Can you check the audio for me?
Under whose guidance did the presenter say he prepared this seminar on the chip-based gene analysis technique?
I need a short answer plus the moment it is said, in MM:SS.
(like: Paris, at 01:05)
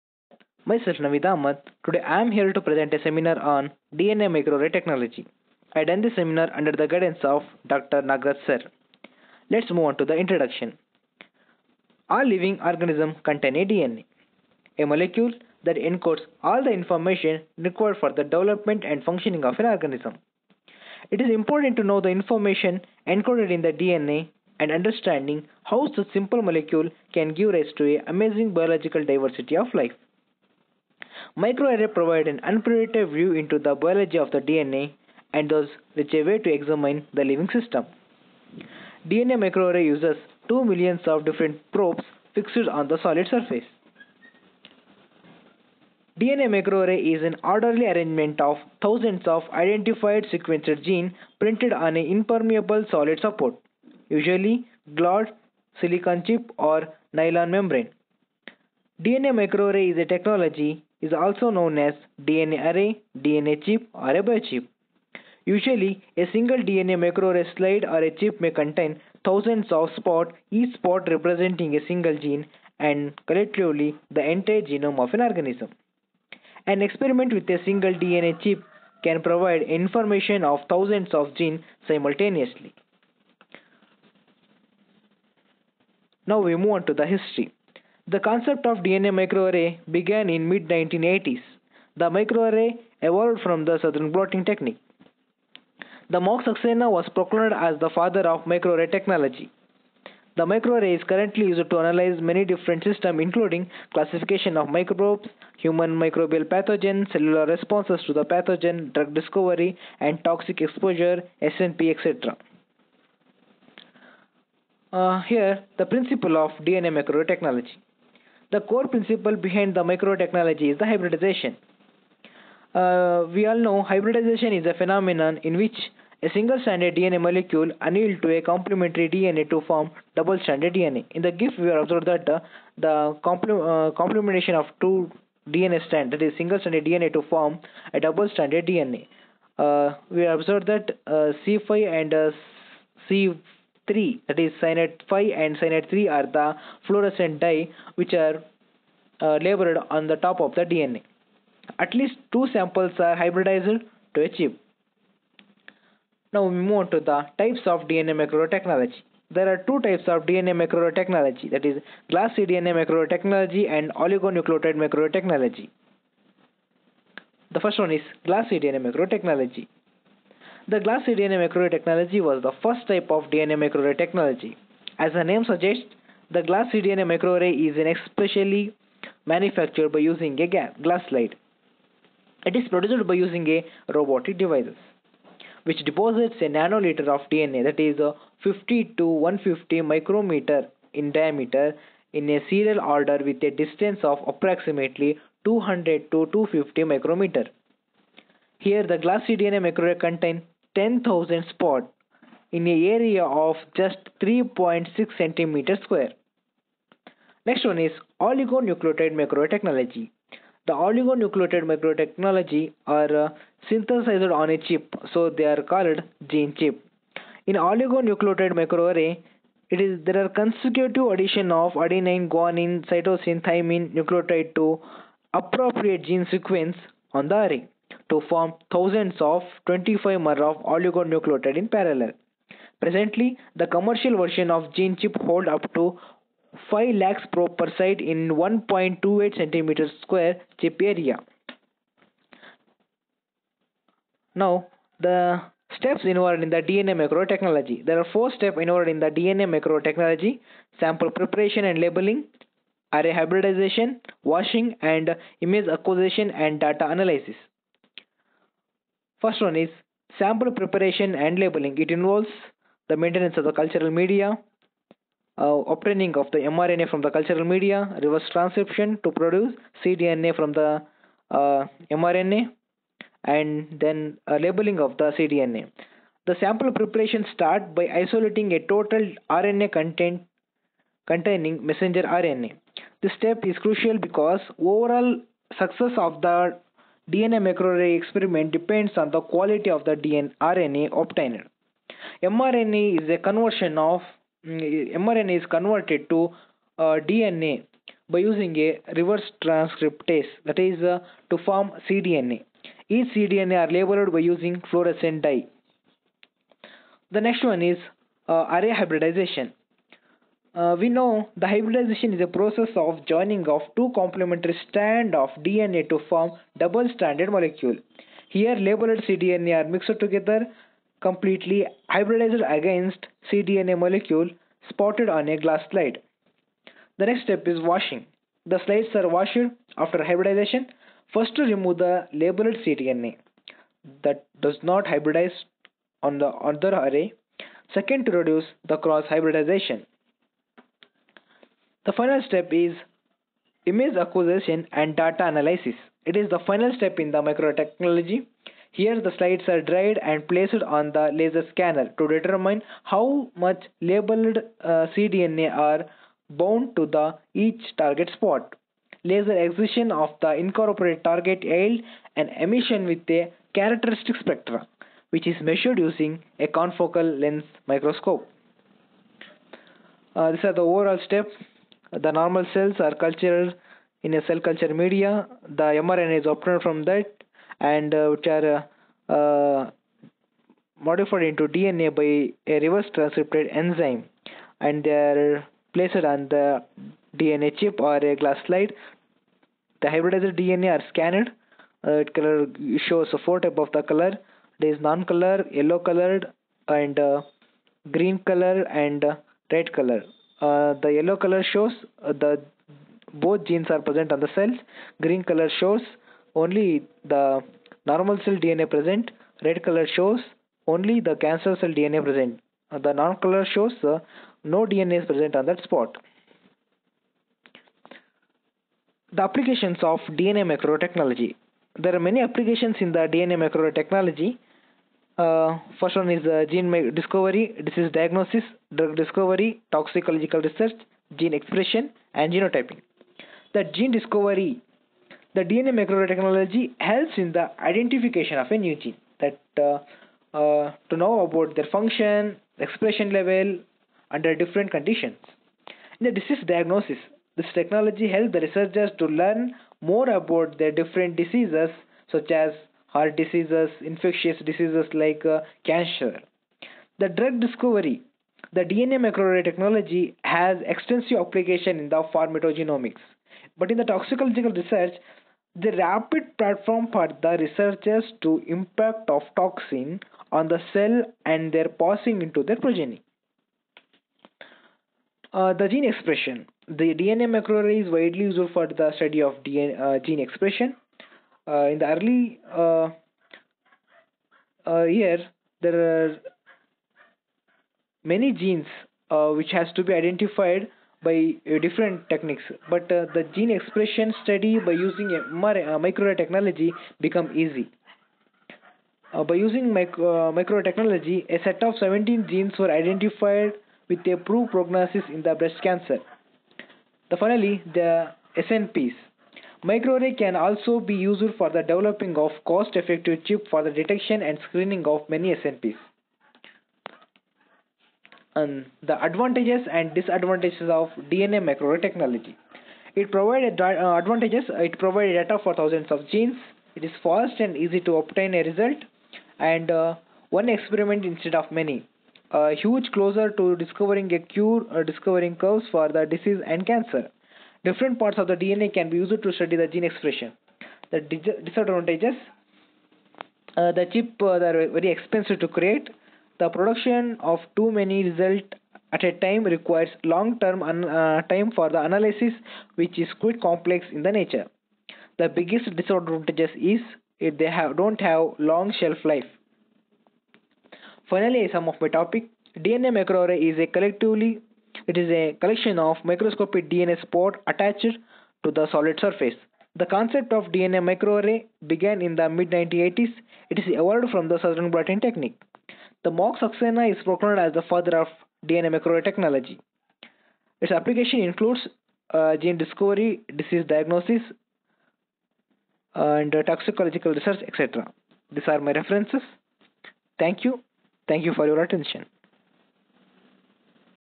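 Dr. Nagrat, at 00:07.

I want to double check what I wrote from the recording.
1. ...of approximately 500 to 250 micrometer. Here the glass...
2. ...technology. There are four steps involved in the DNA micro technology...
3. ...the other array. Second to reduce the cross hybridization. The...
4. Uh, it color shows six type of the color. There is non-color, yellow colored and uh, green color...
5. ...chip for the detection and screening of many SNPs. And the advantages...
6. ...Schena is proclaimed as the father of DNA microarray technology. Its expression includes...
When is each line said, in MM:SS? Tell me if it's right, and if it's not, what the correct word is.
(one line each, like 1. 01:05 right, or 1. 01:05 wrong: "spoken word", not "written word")
1. 03:14 wrong: "200", not "500"
2. 04:07 right
3. 05:36 right
4. 06:31 wrong: "four", not "six"
5. 08:33 right
6. 09:36 wrong: "application", not "expression".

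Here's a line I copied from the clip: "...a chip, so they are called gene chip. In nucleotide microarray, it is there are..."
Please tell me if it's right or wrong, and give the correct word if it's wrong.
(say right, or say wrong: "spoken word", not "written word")
wrong: "oligonucleotide", not "nucleotide".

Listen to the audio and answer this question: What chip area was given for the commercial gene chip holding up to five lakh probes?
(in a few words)
1.28 cm².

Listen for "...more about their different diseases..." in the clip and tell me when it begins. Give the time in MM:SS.
07:29.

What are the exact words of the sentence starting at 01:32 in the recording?
The microarray evolved from the southern blotting technique.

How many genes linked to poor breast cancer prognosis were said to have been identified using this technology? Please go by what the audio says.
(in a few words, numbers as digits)
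17.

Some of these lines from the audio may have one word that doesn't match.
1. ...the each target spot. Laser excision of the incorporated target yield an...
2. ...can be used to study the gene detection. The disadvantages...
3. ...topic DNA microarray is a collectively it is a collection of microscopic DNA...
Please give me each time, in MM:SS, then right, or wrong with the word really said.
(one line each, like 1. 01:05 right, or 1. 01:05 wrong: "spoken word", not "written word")
1. 05:56 right
2. 08:58 wrong: "expression", not "detection"
3. 09:21 right.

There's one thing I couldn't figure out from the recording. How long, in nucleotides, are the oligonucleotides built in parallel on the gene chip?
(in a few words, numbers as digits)
25-mer.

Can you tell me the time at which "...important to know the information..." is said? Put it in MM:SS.
00:21.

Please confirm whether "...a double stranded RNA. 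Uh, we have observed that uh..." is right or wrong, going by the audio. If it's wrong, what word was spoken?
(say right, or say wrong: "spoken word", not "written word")
wrong: "DNA", not "RNA".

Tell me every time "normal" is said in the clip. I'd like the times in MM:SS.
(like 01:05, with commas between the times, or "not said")
06:12, 06:47.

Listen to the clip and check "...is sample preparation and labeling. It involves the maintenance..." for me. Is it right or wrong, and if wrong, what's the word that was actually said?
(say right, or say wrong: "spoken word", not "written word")
right.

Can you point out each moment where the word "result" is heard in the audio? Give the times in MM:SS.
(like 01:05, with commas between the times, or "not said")
08:48, 09:08.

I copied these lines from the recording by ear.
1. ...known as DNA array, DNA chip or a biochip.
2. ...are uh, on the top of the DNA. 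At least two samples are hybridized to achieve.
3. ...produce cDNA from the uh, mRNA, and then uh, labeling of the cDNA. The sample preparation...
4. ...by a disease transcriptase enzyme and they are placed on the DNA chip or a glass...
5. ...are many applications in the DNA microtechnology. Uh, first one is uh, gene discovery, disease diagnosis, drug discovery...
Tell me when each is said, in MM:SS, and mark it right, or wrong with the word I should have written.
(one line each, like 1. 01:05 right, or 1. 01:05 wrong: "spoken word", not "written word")
1. 01:01 right
2. 02:28 right
3. 04:29 right
4. 06:21 wrong: "reverse", not "disease"
5. 07:01 right.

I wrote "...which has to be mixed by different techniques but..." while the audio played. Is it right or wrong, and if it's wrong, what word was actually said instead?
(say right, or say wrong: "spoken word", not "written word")
wrong: "identified", not "mixed".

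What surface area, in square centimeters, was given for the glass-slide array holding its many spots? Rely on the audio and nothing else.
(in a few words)
3.6 cm².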